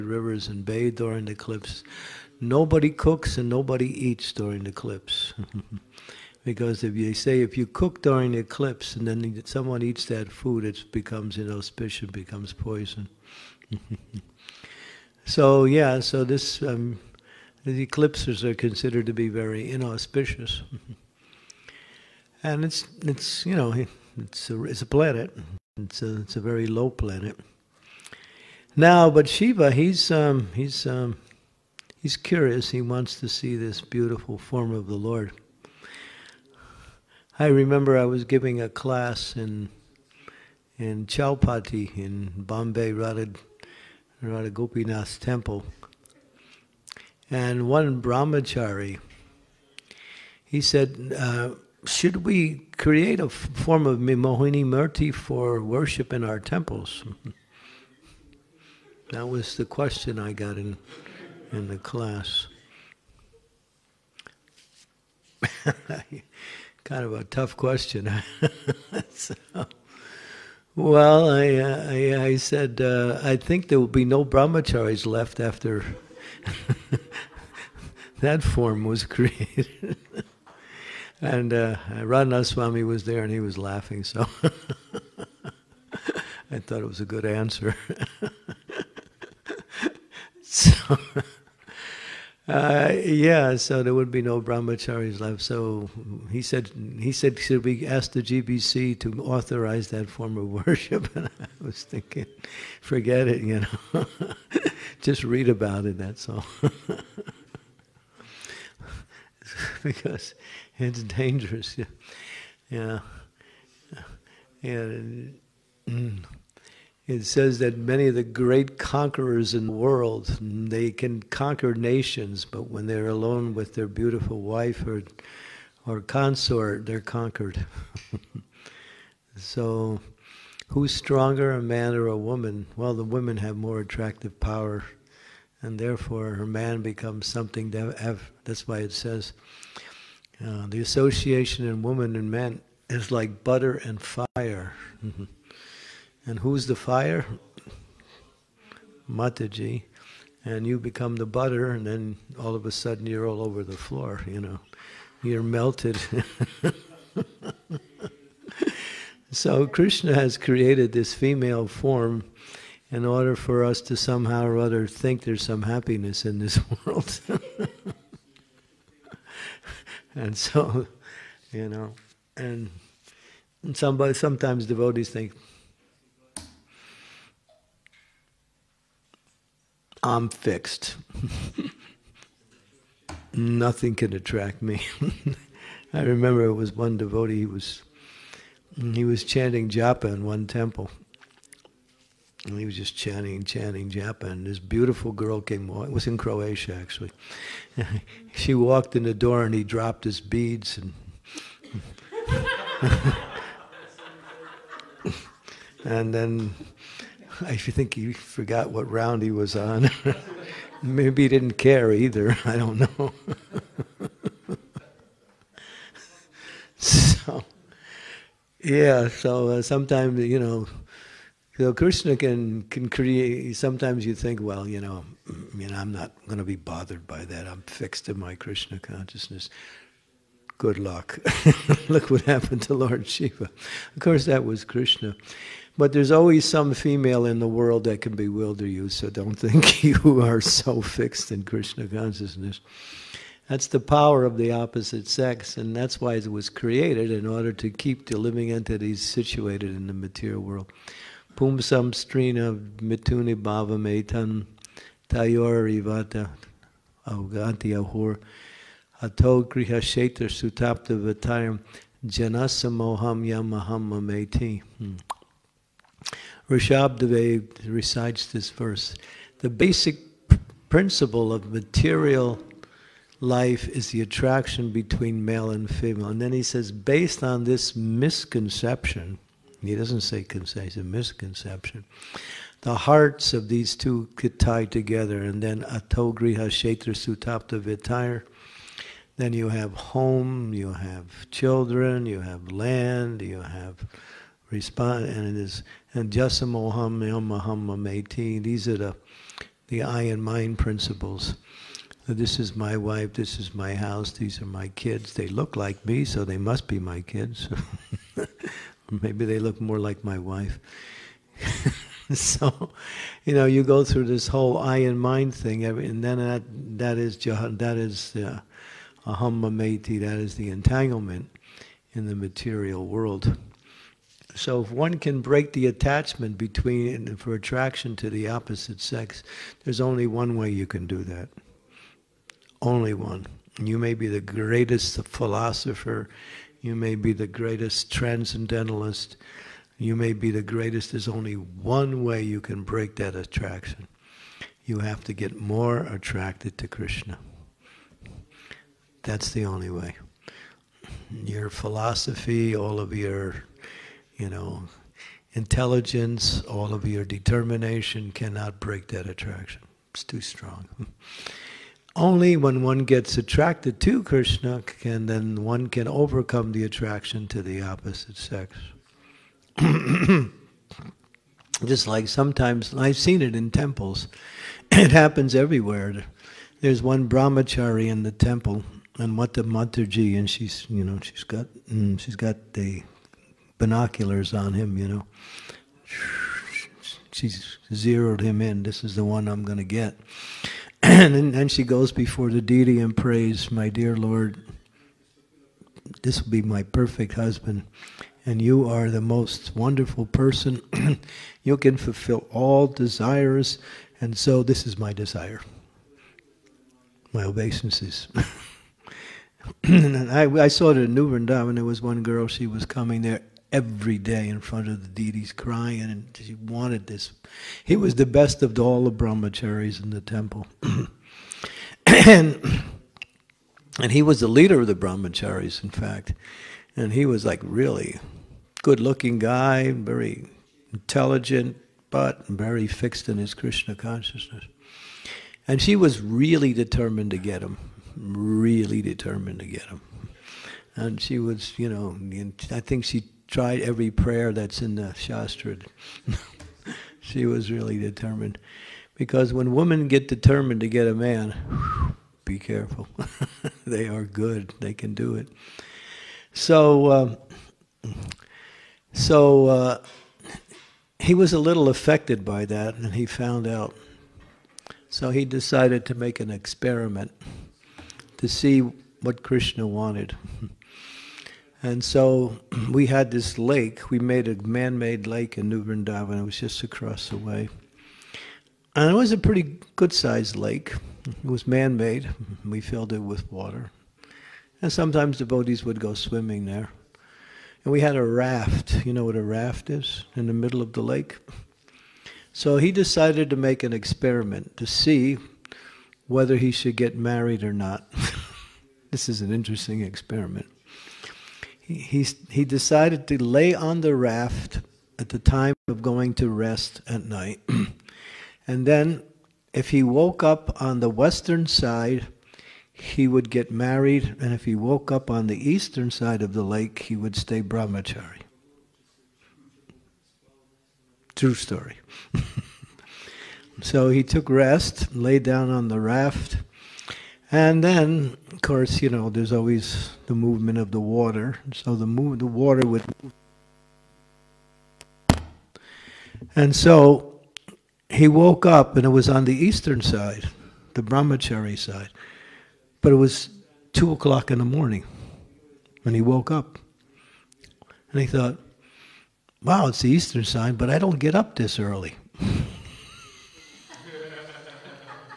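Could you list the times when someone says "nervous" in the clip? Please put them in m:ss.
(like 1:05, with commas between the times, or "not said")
not said.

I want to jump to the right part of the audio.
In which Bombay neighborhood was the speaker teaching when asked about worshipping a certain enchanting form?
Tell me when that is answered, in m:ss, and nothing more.
0:41.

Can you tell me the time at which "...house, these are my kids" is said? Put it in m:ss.
5:03.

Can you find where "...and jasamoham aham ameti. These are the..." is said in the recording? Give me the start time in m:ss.
4:55.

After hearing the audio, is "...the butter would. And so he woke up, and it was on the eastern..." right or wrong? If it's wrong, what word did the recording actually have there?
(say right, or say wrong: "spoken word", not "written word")
wrong: "water", not "butter".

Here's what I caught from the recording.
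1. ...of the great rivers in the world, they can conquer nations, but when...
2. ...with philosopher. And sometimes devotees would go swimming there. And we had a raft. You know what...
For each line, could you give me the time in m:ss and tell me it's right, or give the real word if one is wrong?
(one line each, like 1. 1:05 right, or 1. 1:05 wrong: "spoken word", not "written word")
1. 1:58 wrong: "conquerors", not "rivers"
2. 8:02 wrong: "water", not "philosopher".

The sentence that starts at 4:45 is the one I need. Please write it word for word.
And then atogriha shetra sutapta vitire.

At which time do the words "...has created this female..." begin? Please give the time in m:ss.
2:40.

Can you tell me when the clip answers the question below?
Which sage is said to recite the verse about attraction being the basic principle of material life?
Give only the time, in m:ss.
4:26.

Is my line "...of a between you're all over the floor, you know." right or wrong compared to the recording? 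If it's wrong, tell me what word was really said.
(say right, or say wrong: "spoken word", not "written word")
wrong: "sudden", not "between".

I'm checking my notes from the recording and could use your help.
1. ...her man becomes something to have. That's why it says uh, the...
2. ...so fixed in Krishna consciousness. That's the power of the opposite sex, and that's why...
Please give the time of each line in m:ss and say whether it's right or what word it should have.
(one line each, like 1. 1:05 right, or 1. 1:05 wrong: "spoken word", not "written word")
1. 2:16 right
2. 4:00 right.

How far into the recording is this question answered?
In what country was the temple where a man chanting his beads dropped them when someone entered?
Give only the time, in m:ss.
3:16.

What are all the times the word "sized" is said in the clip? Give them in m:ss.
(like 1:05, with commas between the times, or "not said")
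7:59.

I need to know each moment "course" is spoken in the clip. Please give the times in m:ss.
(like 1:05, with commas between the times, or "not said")
3:53, 8:48.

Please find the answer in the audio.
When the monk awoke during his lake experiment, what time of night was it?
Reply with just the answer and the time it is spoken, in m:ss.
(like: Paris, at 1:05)
2:00 a.m., at 9:03.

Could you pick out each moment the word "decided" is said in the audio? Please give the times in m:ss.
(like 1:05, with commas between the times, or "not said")
7:45, 8:12, 8:22.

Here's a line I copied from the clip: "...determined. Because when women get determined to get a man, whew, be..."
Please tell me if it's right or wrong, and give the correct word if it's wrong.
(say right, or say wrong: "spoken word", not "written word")
right.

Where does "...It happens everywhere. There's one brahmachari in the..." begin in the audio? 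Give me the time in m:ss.
6:14.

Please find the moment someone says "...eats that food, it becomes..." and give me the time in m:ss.
0:09.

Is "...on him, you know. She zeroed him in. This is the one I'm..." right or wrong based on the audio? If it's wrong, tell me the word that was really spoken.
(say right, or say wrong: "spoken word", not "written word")
right.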